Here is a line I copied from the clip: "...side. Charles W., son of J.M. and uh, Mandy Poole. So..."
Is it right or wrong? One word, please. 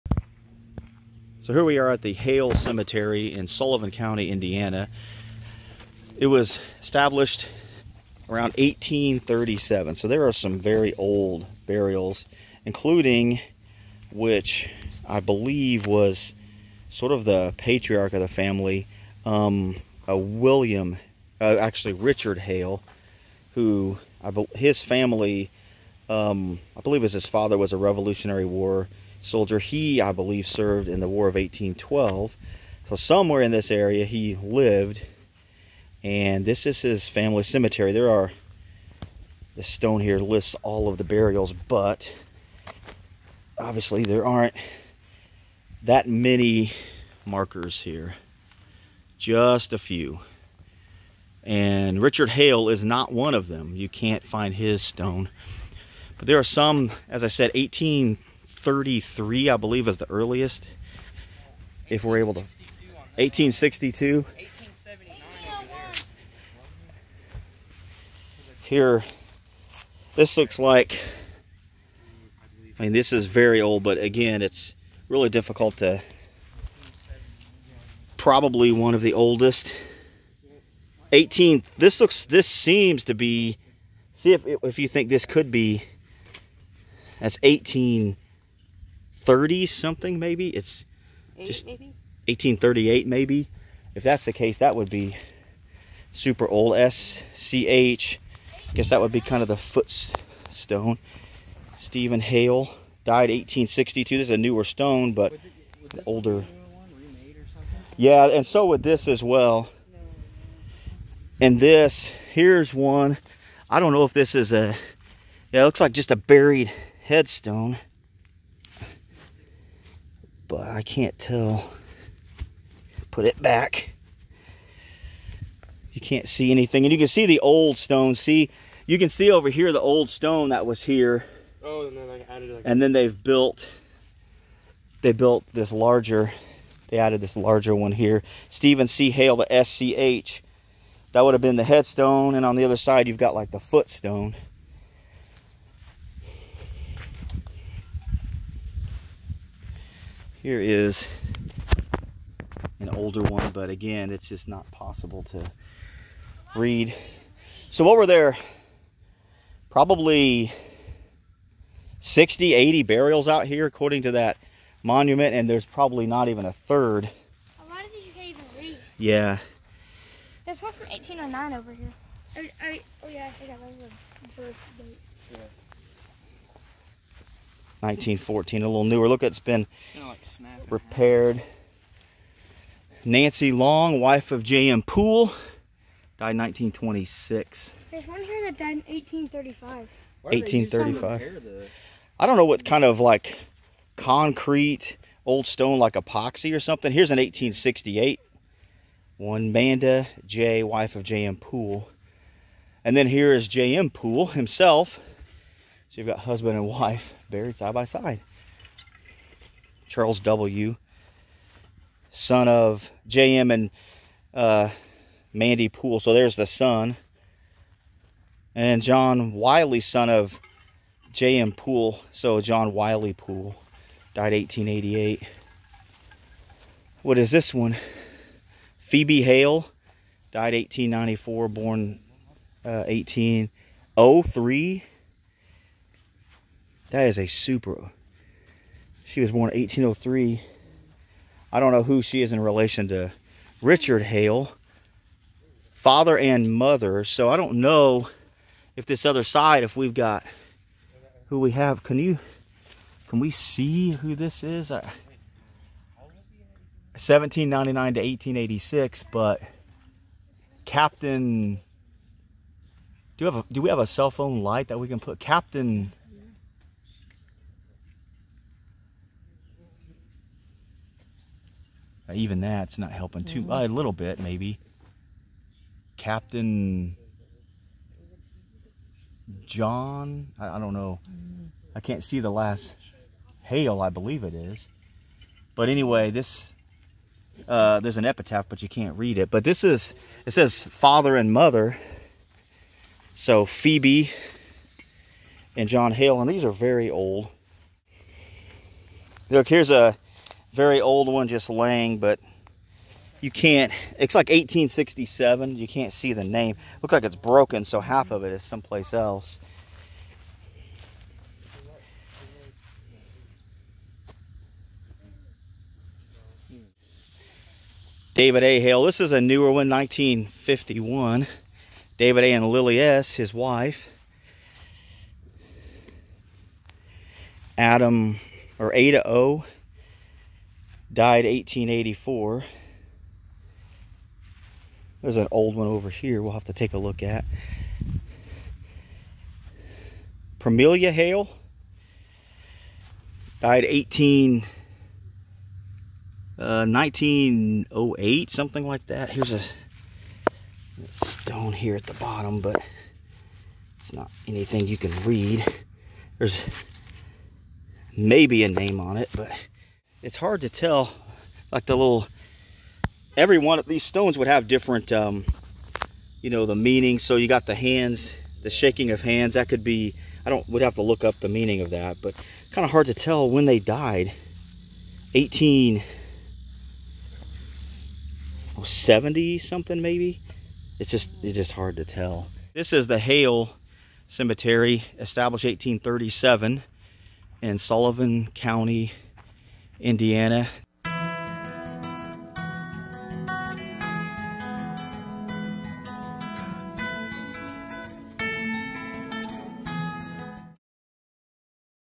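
right.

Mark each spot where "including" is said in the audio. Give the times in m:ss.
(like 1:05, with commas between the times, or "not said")
0:12.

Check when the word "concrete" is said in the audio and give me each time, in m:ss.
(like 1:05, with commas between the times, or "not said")
3:13.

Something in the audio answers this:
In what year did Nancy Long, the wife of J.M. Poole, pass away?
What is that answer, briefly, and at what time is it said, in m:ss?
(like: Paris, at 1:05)
1926, at 3:06.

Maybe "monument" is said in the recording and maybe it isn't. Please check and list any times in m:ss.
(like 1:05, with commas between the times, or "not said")
2:44.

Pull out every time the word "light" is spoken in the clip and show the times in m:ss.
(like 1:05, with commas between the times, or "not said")
4:24.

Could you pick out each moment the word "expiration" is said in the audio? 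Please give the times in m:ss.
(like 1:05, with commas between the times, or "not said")
not said.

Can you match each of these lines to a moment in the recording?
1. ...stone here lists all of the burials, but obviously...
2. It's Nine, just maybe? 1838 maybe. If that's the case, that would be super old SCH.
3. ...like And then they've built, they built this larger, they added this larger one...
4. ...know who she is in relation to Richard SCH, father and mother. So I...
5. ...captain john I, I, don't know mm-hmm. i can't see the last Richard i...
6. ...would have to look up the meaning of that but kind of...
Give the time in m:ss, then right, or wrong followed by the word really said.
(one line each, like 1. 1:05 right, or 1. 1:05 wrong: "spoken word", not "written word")
1. 0:39 right
2. 1:30 wrong: "Eight", not "Nine"
3. 2:12 right
4. 4:01 wrong: "Hale", not "SCH"
5. 4:35 wrong: "Hale", not "Richard"
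6. 6:10 right.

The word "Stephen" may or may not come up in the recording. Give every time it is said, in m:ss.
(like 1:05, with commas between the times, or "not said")
1:41, 2:18.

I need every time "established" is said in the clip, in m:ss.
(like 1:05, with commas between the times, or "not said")
0:06, 6:24.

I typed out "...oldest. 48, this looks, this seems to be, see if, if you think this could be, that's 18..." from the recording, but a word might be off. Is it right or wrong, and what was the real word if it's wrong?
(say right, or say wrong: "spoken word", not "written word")
wrong: "18", not "48".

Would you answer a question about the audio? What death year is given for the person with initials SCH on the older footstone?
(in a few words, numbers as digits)
1862.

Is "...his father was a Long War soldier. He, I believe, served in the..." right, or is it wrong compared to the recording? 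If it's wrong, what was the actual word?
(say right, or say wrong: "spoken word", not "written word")
wrong: "Revolutionary", not "Long".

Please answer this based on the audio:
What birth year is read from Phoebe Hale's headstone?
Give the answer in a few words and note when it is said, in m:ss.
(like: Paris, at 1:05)
1803, at 3:51.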